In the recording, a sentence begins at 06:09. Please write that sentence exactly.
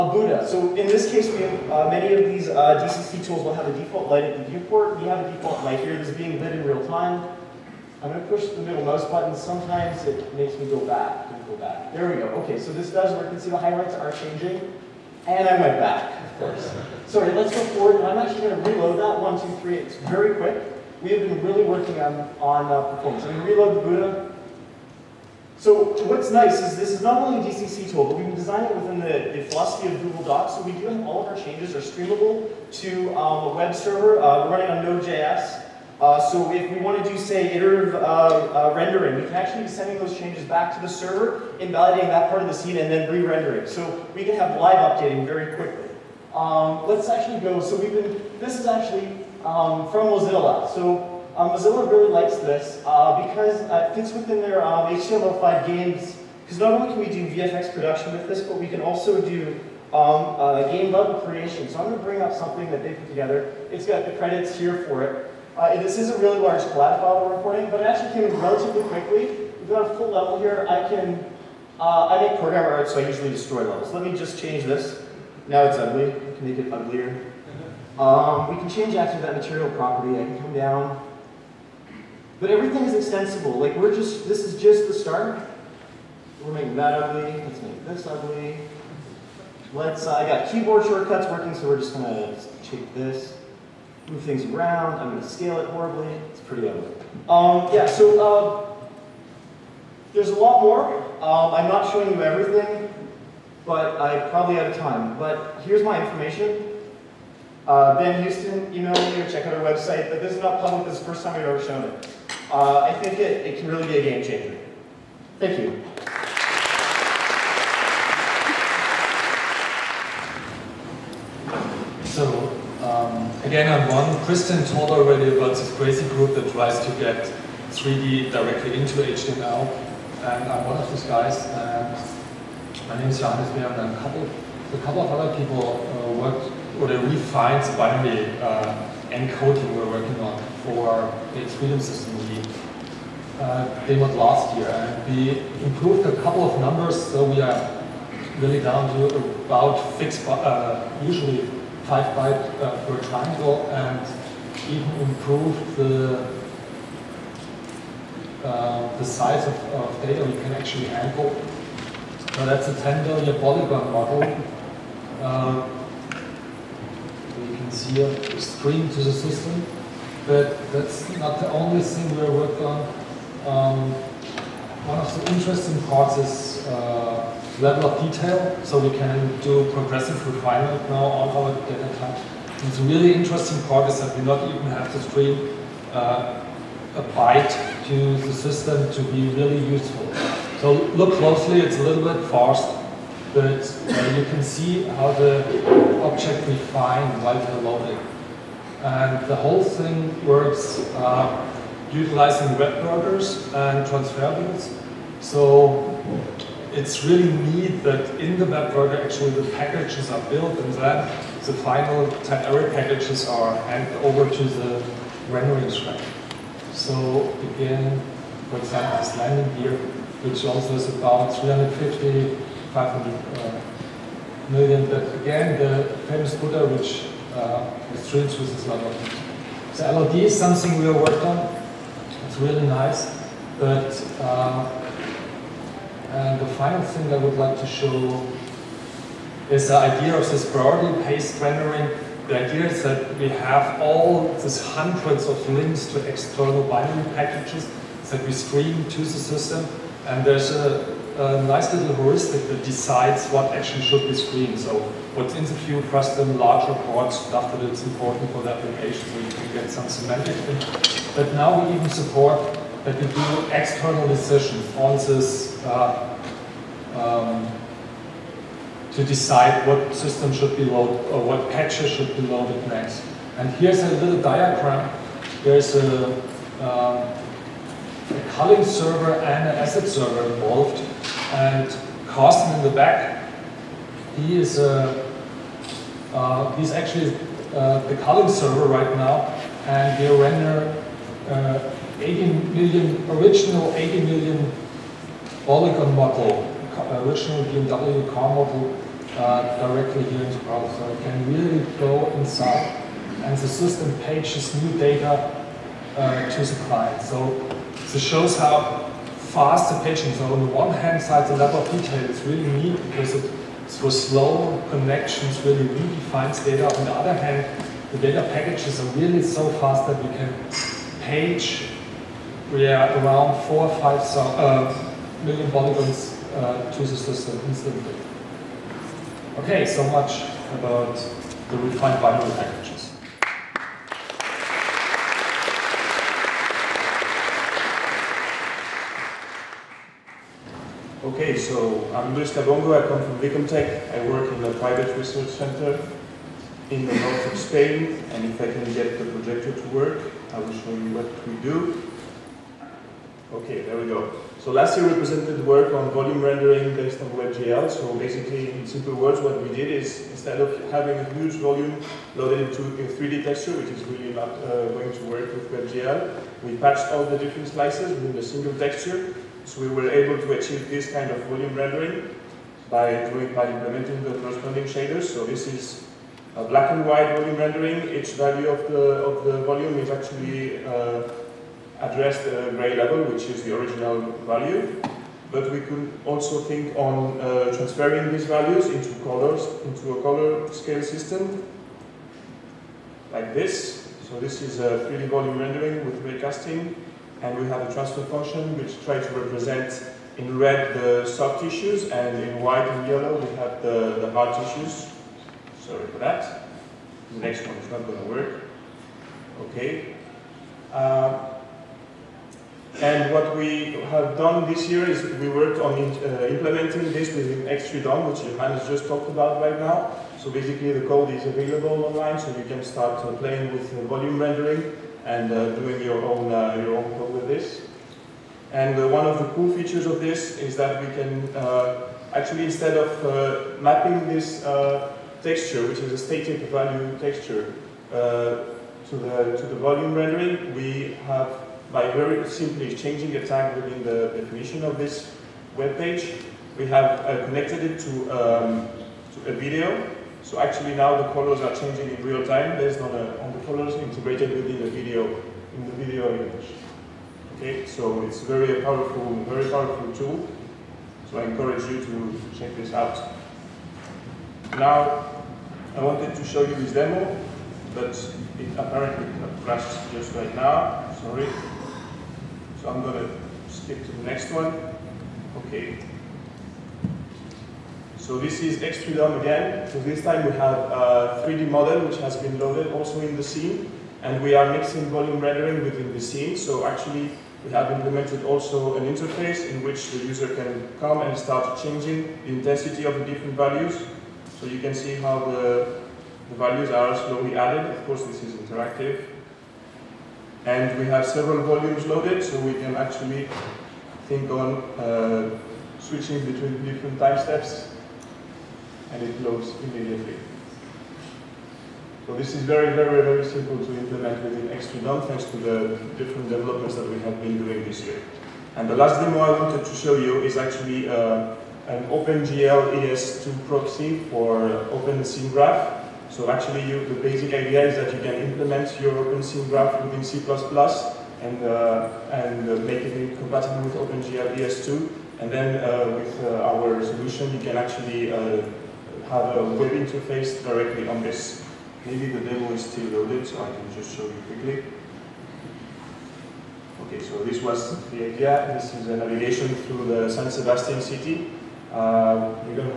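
So we were able to achieve this kind of volume rendering by doing by implementing the corresponding shaders.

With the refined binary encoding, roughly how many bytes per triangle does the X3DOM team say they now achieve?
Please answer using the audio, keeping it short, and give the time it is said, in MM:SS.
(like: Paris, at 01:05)
5, at 02:31.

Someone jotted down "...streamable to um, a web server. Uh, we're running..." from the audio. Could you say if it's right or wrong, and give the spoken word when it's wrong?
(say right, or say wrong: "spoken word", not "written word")
right.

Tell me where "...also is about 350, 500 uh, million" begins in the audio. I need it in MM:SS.
03:40.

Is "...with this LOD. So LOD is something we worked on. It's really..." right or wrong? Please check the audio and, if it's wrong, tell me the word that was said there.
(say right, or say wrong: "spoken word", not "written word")
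right.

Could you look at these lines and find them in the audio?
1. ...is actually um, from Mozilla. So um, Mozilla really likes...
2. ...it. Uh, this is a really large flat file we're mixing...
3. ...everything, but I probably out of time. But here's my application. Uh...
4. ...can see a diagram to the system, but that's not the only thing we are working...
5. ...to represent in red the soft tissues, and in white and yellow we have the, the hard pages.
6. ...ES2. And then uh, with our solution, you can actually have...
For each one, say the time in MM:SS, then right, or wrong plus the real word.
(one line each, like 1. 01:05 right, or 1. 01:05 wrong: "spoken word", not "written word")
1. 00:48 right
2. 01:05 wrong: "importing", not "mixing"
3. 01:42 wrong: "information", not "application"
4. 02:47 wrong: "stream", not "diagram"
5. 06:39 wrong: "tissues", not "pages"
6. 08:54 right.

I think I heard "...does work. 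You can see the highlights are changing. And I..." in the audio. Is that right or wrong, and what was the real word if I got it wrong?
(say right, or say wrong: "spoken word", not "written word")
right.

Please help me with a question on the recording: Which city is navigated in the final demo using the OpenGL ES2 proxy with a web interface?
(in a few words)
San Sebastian.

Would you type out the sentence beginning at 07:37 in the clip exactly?
Okay, so it's very powerful, very powerful tool.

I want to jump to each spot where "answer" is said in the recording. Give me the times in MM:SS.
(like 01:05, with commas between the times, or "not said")
not said.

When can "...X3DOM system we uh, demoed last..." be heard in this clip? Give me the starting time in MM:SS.
02:21.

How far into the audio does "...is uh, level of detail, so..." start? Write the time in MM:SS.
02:56.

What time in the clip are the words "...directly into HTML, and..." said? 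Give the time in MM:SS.
02:08.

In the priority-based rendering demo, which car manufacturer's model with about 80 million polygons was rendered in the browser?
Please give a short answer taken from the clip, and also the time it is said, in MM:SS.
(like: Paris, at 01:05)
BMW, at 04:57.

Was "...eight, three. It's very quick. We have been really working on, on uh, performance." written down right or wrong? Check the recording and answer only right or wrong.
wrong.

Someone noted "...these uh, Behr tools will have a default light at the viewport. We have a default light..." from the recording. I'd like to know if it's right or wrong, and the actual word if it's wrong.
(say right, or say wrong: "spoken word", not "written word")
wrong: "DCC", not "Behr".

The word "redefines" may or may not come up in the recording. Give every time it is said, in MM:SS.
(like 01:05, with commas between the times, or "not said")
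05:15.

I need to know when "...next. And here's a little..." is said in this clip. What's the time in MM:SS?
04:32.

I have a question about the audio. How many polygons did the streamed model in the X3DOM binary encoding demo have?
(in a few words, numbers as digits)
10 billion.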